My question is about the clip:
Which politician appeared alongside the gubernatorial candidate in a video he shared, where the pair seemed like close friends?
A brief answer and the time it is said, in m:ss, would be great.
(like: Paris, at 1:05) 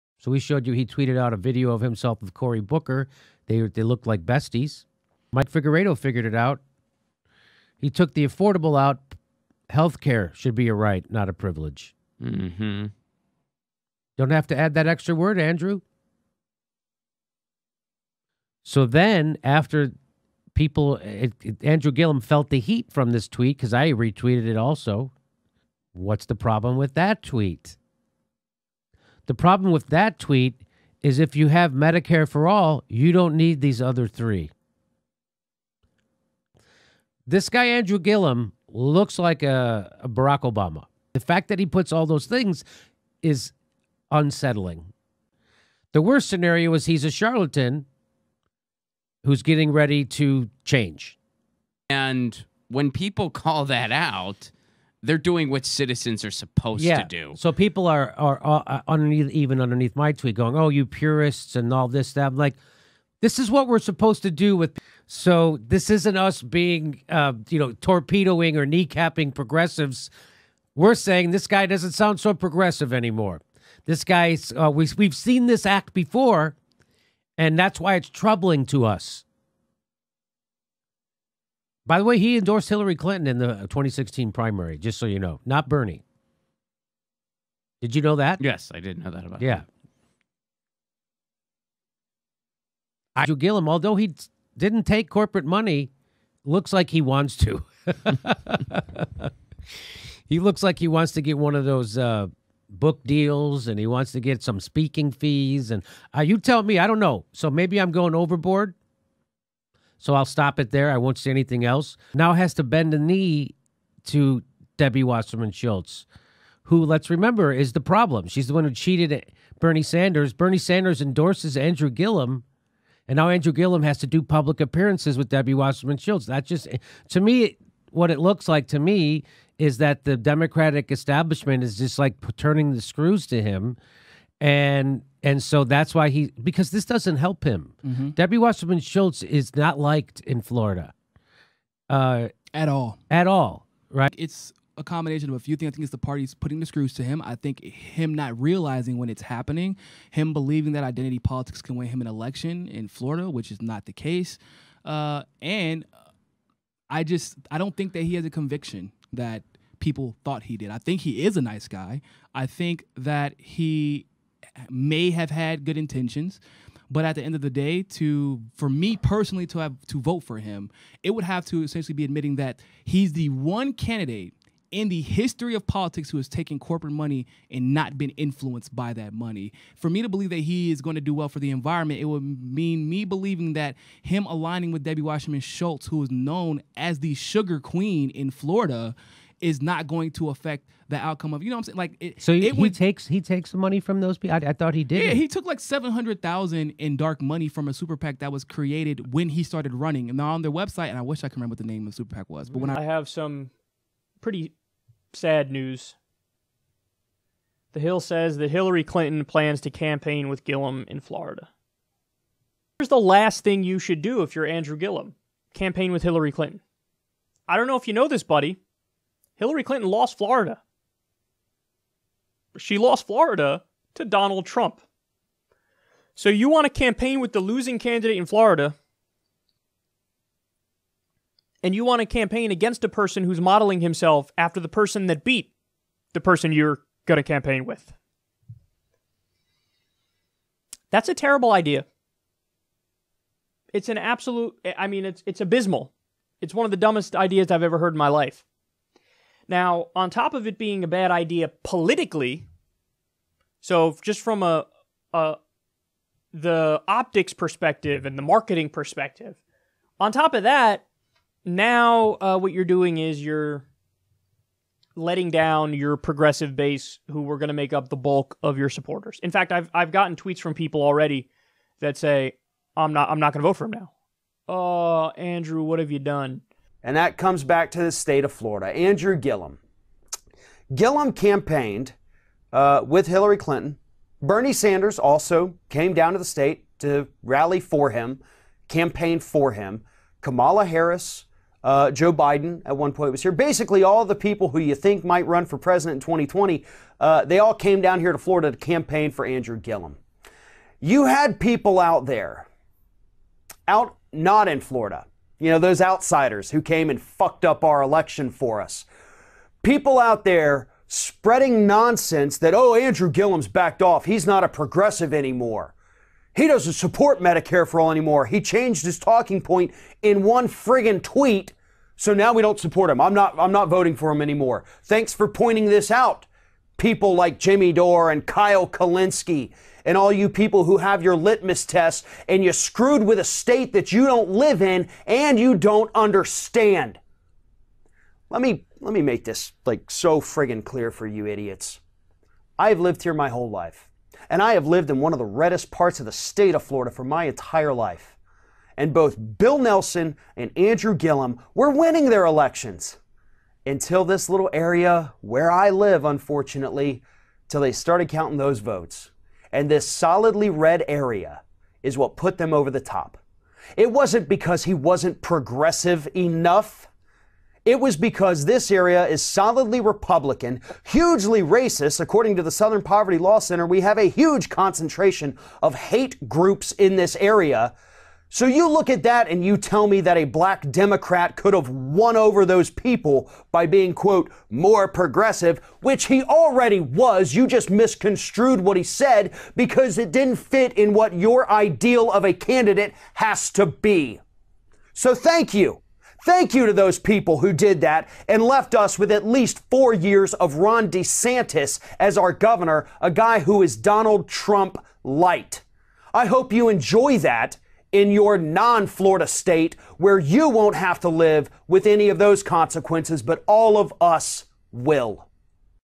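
Cory Booker, at 0:02.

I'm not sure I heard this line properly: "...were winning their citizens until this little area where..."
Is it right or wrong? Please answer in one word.
wrong.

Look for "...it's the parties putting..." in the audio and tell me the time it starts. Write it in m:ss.
2:25.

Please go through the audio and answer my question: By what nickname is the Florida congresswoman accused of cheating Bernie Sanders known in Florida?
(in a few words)
the sugar queen.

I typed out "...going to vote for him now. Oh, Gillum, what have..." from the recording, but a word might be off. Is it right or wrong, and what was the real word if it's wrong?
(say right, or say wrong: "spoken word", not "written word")
wrong: "Andrew", not "Gillum".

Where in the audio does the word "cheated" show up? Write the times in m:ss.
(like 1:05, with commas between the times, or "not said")
1:58.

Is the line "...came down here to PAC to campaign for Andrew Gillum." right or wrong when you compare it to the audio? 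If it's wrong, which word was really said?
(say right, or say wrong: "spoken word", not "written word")
wrong: "Florida", not "PAC".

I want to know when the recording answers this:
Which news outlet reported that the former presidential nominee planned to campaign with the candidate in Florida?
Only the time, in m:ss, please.
3:27.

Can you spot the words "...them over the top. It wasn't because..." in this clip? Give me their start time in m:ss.
6:02.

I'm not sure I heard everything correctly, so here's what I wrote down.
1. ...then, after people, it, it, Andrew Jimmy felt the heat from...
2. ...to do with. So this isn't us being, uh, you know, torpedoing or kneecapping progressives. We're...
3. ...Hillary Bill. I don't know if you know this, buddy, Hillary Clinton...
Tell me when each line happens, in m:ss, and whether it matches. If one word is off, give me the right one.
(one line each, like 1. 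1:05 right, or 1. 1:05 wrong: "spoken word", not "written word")
1. 0:18 wrong: "Gillum", not "Jimmy"
2. 1:04 right
3. 3:36 wrong: "Clinton", not "Bill".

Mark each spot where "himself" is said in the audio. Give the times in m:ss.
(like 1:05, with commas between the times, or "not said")
0:01, 3:53.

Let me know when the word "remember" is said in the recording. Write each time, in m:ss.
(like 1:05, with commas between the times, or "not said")
1:57, 3:21.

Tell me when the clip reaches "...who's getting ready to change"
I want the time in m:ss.
0:49.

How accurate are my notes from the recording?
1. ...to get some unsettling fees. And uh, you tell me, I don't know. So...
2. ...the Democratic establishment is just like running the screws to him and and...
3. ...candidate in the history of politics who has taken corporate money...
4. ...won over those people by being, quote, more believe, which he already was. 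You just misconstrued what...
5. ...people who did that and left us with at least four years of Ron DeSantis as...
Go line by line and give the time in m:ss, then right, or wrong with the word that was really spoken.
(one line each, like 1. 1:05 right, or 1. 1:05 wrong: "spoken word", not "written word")
1. 1:44 wrong: "speaking", not "unsettling"
2. 2:10 wrong: "turning", not "running"
3. 2:53 right
4. 6:21 wrong: "progressive", not "believe"
5. 6:36 right.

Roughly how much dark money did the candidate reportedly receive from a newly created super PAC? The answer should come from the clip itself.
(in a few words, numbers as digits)
$700,000.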